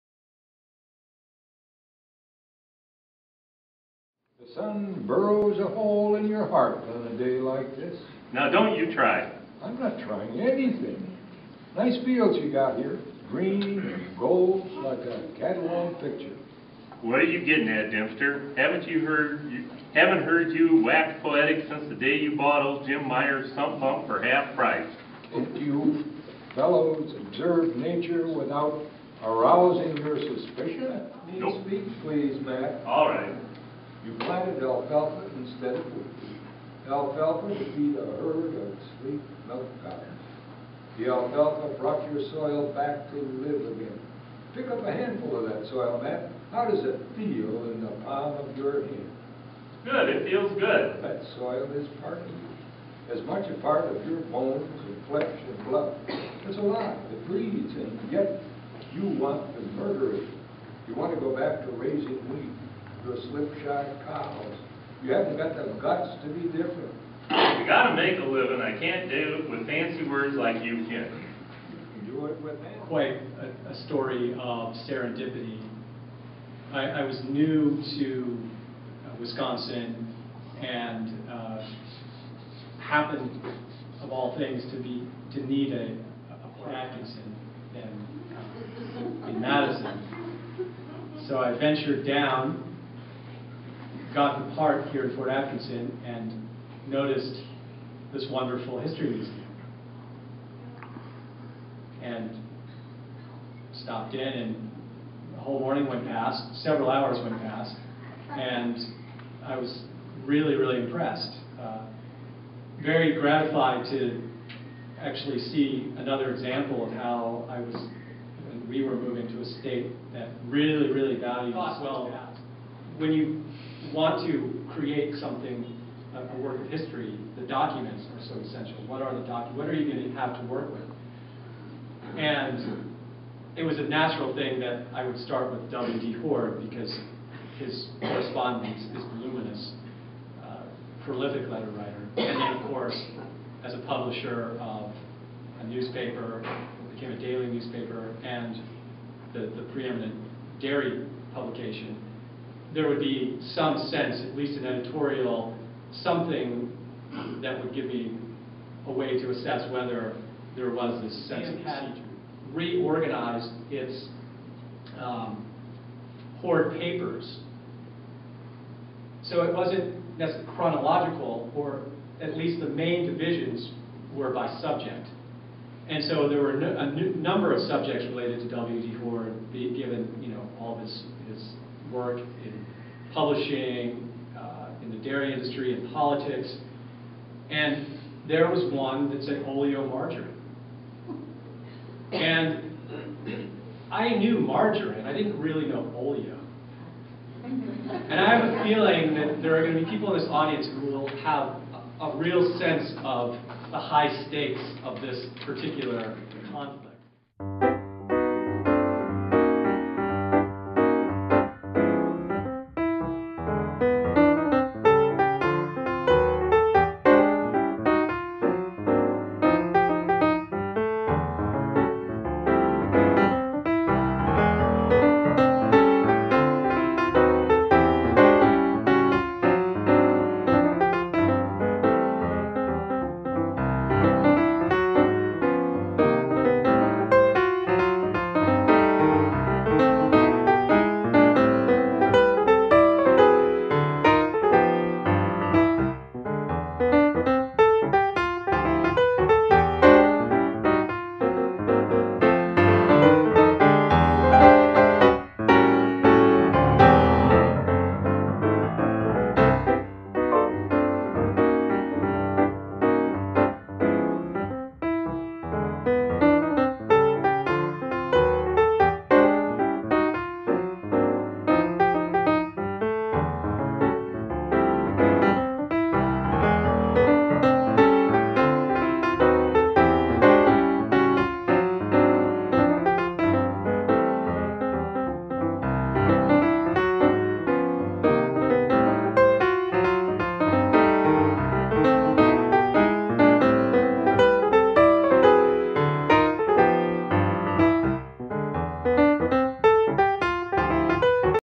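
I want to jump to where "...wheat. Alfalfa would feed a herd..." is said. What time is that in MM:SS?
00:35.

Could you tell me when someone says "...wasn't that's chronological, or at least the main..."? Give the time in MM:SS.
02:49.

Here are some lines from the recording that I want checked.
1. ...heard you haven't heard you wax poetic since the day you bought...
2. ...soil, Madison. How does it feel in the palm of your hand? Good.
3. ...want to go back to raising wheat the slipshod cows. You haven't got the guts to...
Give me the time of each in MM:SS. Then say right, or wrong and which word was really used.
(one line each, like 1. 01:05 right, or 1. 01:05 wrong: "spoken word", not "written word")
1. 00:19 right
2. 00:45 wrong: "Matt", not "Madison"
3. 01:00 right.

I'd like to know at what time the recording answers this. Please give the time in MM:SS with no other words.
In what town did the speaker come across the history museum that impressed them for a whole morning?
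01:35.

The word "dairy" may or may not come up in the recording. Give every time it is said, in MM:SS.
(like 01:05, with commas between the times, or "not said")
02:30, 03:04.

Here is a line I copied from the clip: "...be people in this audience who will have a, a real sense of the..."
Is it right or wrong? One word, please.
right.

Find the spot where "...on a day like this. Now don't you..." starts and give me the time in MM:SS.
00:06.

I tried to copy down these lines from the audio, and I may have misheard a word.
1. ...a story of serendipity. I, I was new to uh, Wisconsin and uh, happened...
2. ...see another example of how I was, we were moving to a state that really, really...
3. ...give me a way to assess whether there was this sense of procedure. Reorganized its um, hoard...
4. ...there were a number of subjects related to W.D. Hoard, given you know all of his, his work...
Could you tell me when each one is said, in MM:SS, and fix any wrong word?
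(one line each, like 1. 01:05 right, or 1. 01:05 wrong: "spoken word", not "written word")
1. 01:13 right
2. 01:55 right
3. 02:37 right
4. 02:56 right.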